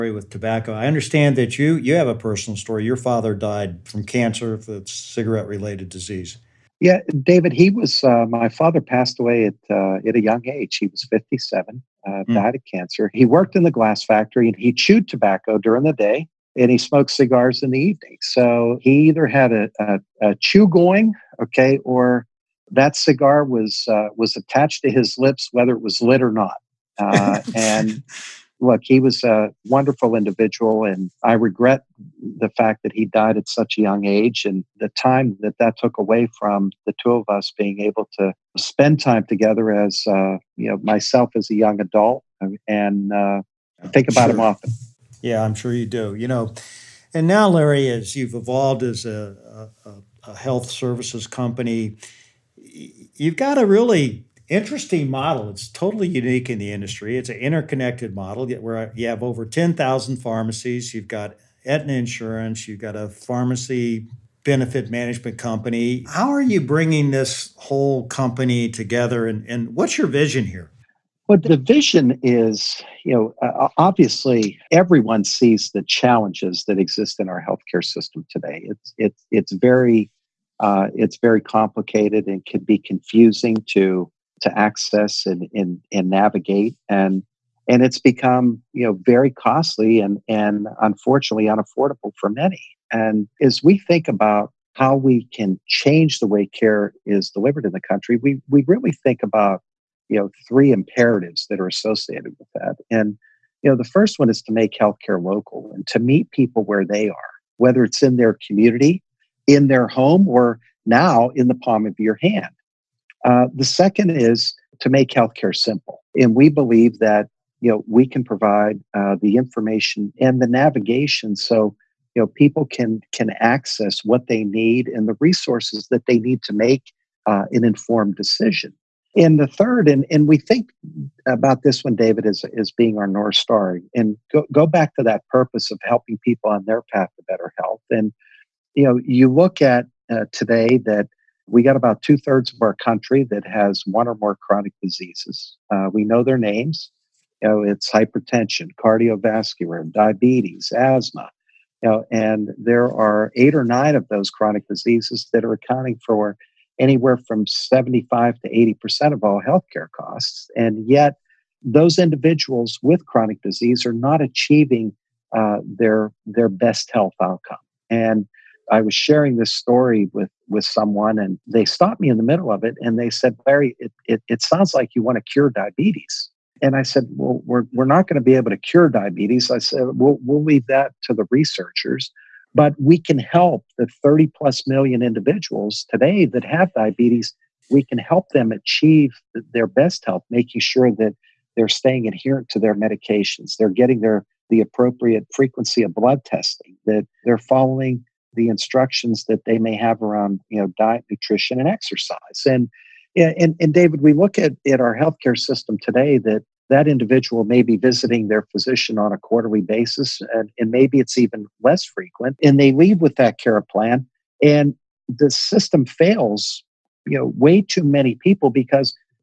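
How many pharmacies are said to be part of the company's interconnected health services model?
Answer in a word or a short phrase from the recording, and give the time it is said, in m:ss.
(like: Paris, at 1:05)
Over 10,000, at 0:59.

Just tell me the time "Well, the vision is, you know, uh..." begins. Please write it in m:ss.
1:11.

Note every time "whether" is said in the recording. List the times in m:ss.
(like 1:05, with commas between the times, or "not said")
0:25, 1:47.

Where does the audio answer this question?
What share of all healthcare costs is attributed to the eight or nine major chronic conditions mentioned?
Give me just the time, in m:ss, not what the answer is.
2:37.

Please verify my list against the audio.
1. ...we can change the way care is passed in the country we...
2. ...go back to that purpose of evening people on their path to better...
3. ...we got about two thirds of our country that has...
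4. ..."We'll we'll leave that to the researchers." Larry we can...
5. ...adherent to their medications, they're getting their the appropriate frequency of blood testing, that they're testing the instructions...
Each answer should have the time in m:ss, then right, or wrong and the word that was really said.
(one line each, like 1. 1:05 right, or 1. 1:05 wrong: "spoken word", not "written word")
1. 1:34 wrong: "delivered", not "passed"
2. 2:14 wrong: "helping", not "evening"
3. 2:21 right
4. 2:59 wrong: "But", not "Larry"
5. 3:12 wrong: "following", not "testing".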